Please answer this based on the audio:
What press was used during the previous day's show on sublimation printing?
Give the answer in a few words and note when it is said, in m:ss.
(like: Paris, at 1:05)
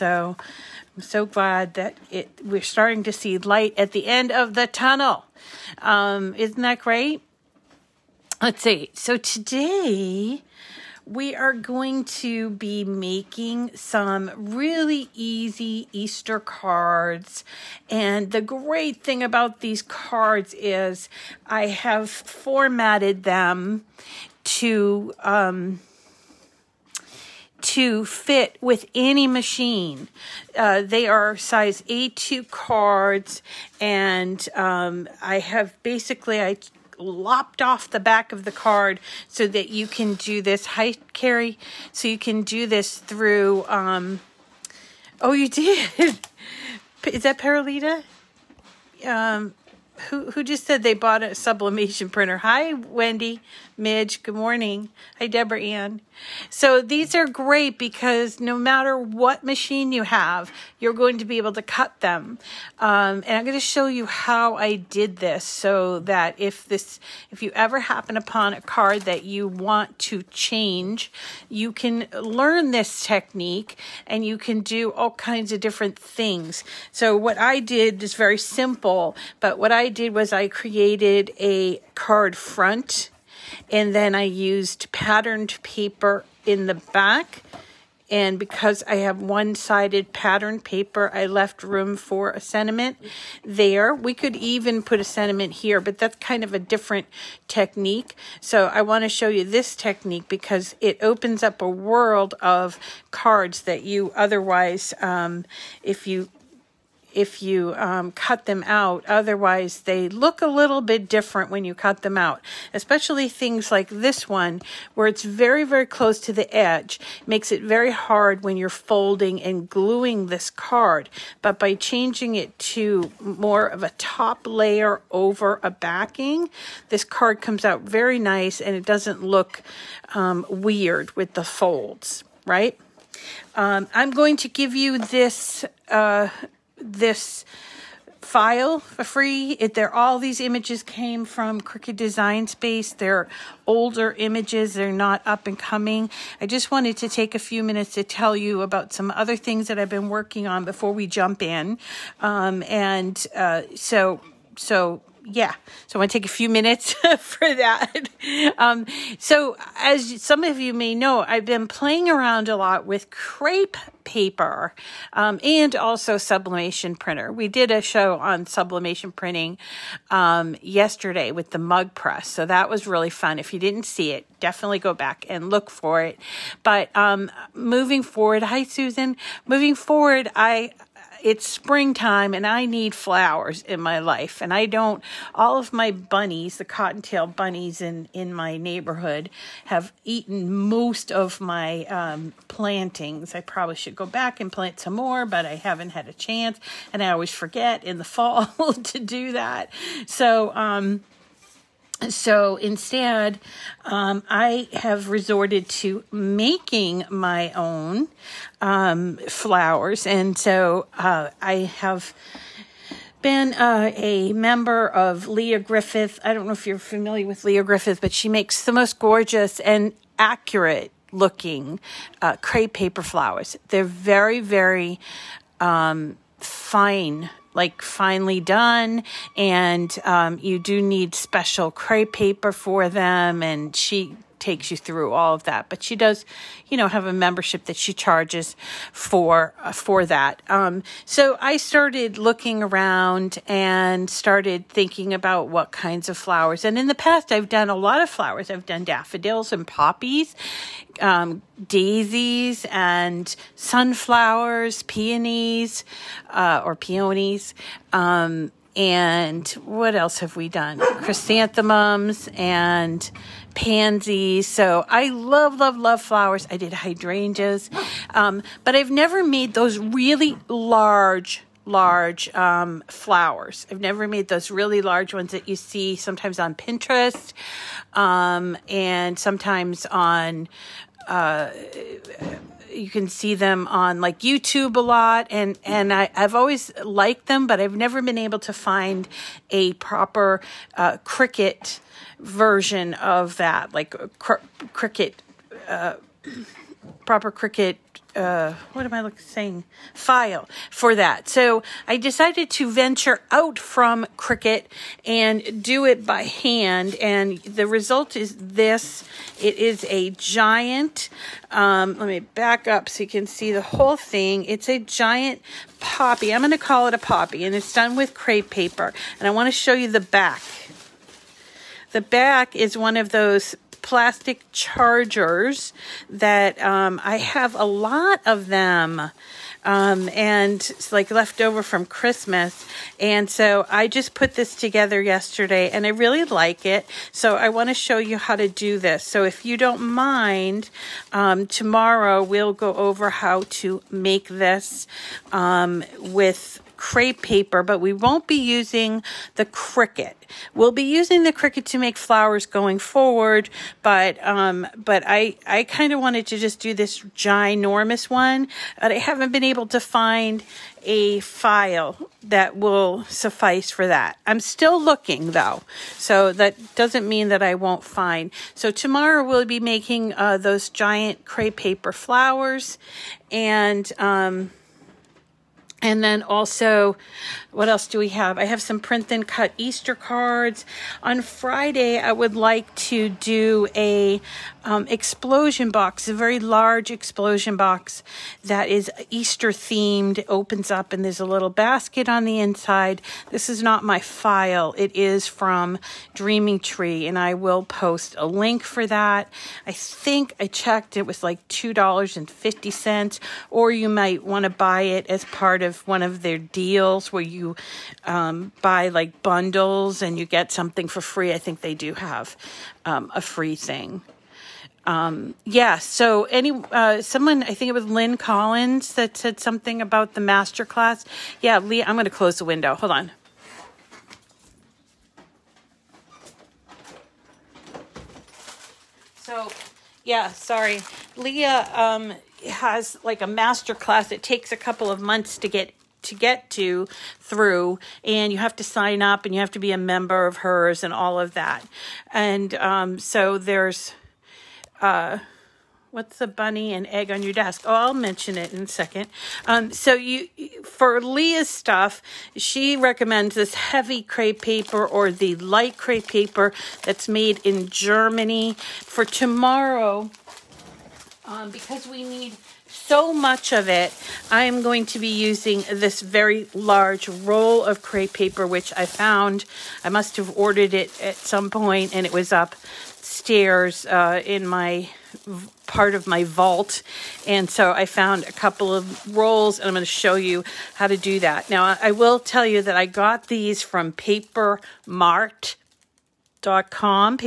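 mug press, at 2:51.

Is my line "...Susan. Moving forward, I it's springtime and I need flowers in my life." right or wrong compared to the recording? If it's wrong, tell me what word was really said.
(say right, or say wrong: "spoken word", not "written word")
right.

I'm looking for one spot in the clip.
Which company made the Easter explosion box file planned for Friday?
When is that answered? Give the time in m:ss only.
6:36.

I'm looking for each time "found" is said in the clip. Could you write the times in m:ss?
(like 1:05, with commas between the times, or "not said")
7:48, 7:57.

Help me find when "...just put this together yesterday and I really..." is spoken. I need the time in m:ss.
5:33.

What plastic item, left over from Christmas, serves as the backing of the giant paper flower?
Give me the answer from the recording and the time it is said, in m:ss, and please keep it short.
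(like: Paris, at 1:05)
chargers, at 5:23.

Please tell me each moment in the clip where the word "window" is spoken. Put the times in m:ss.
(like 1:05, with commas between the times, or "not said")
7:02.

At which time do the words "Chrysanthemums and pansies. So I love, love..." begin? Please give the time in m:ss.
4:20.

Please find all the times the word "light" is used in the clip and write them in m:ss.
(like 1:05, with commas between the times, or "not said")
0:03, 7:35.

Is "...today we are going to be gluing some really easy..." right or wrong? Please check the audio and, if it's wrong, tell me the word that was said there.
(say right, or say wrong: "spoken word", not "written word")
wrong: "making", not "gluing".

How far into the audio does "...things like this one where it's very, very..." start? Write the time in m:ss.
1:53.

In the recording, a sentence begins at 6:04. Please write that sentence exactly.
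I'm still looking though, so that doesn't mean that I won't find.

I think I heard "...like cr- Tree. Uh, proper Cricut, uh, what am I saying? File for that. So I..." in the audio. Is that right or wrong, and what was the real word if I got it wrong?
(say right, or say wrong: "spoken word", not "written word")
wrong: "Cricut", not "Tree".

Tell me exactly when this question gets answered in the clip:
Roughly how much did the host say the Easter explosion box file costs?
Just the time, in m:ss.
6:41.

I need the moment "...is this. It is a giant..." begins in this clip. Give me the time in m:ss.
5:08.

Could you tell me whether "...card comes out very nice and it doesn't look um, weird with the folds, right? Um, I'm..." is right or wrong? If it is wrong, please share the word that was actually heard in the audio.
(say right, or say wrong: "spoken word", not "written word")
right.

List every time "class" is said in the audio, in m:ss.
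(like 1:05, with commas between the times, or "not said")
7:00, 7:13.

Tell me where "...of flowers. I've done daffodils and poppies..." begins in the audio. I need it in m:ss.
4:08.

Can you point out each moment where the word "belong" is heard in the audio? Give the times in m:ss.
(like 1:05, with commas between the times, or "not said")
not said.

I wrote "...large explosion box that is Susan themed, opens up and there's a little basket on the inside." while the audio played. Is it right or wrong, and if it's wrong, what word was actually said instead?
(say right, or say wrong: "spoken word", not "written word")
wrong: "Easter", not "Susan".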